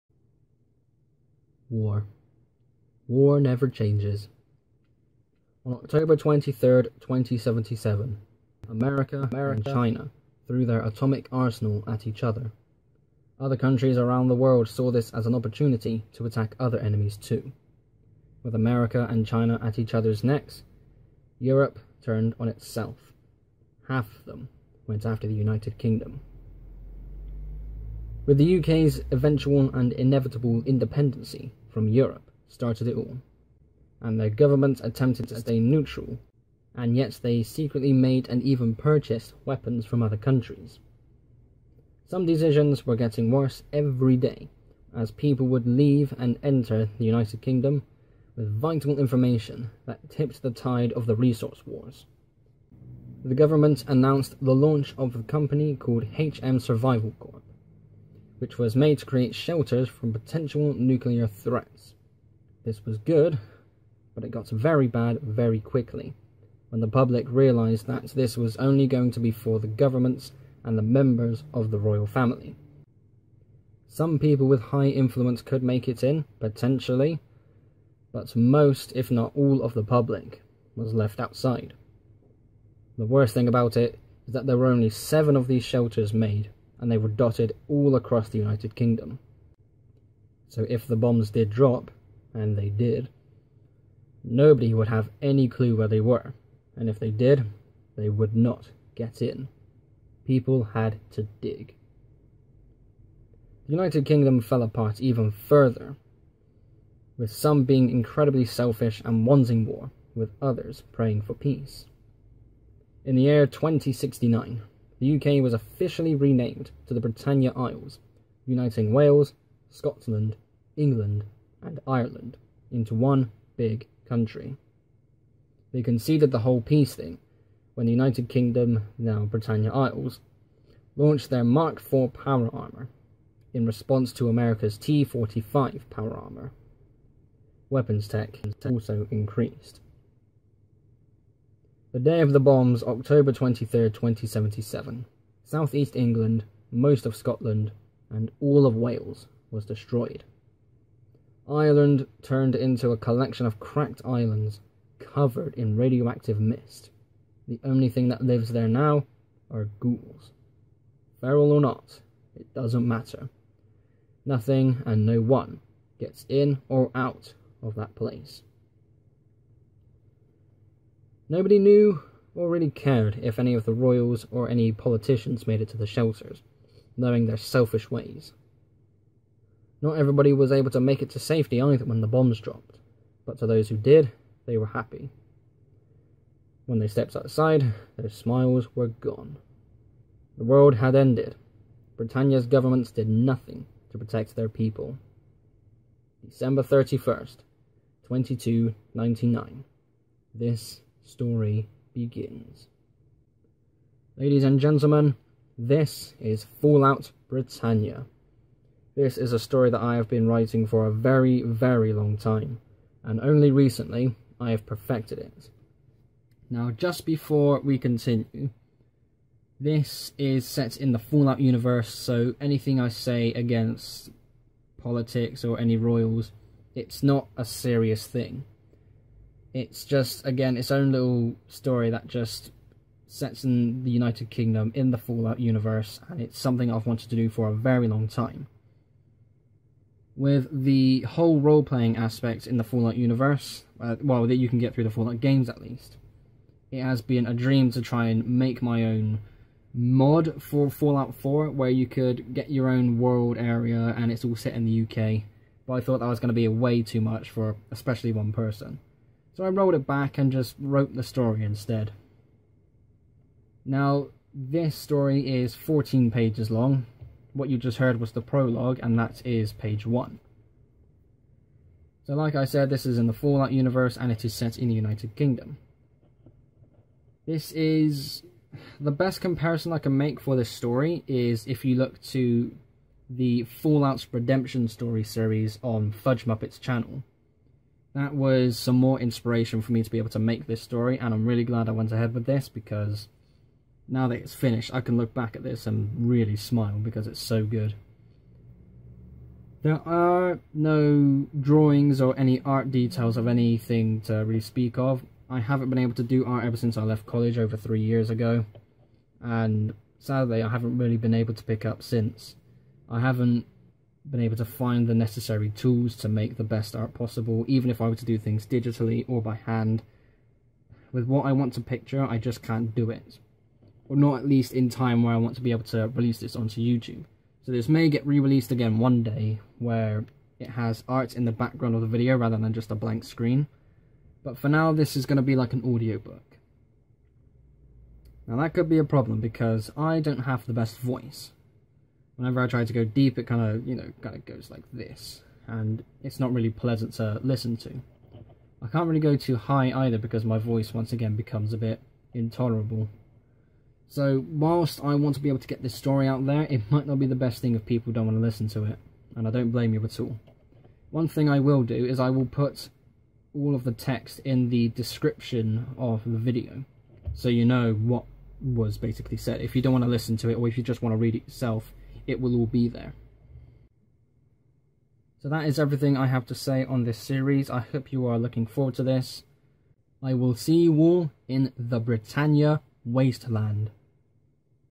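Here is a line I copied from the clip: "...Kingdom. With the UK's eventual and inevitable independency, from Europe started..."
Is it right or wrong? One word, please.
right.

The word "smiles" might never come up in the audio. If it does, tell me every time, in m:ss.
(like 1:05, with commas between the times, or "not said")
3:08, 4:56.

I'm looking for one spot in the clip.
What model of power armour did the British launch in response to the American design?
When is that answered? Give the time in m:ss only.
2:11.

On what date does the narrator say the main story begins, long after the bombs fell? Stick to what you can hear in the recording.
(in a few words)
December 31st, 2299.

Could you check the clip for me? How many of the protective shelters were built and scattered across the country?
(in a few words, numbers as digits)
7.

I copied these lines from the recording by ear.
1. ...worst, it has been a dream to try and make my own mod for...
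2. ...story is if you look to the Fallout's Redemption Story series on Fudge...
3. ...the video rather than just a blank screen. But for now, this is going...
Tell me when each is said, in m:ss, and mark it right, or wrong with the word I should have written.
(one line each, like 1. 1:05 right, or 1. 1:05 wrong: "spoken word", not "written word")
1. 4:05 wrong: "least", not "worst"
2. 4:40 right
3. 5:31 right.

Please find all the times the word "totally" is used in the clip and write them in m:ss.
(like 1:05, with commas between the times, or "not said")
not said.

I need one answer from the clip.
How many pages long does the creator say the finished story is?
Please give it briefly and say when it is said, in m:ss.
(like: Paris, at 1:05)
14, at 4:25.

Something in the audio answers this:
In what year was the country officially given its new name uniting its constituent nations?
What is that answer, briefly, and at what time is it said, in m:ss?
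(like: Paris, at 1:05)
2069, at 1:53.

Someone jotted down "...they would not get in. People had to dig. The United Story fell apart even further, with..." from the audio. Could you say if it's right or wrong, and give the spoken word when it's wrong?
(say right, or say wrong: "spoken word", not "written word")
wrong: "Kingdom", not "Story".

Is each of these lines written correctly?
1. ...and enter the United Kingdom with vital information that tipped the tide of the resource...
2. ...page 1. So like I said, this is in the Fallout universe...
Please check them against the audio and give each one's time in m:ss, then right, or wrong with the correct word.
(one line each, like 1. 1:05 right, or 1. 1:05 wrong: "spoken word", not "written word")
1. 0:46 right
2. 4:29 right.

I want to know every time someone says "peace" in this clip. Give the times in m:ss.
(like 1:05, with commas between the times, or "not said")
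1:51, 2:06.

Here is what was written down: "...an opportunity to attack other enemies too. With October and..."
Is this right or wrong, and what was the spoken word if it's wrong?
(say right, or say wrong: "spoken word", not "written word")
wrong: "America", not "October".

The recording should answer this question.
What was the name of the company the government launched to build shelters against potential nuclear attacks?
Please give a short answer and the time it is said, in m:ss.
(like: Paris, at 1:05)
HM Survival Corp, at 0:56.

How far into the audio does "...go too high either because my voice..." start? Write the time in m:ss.
5:48.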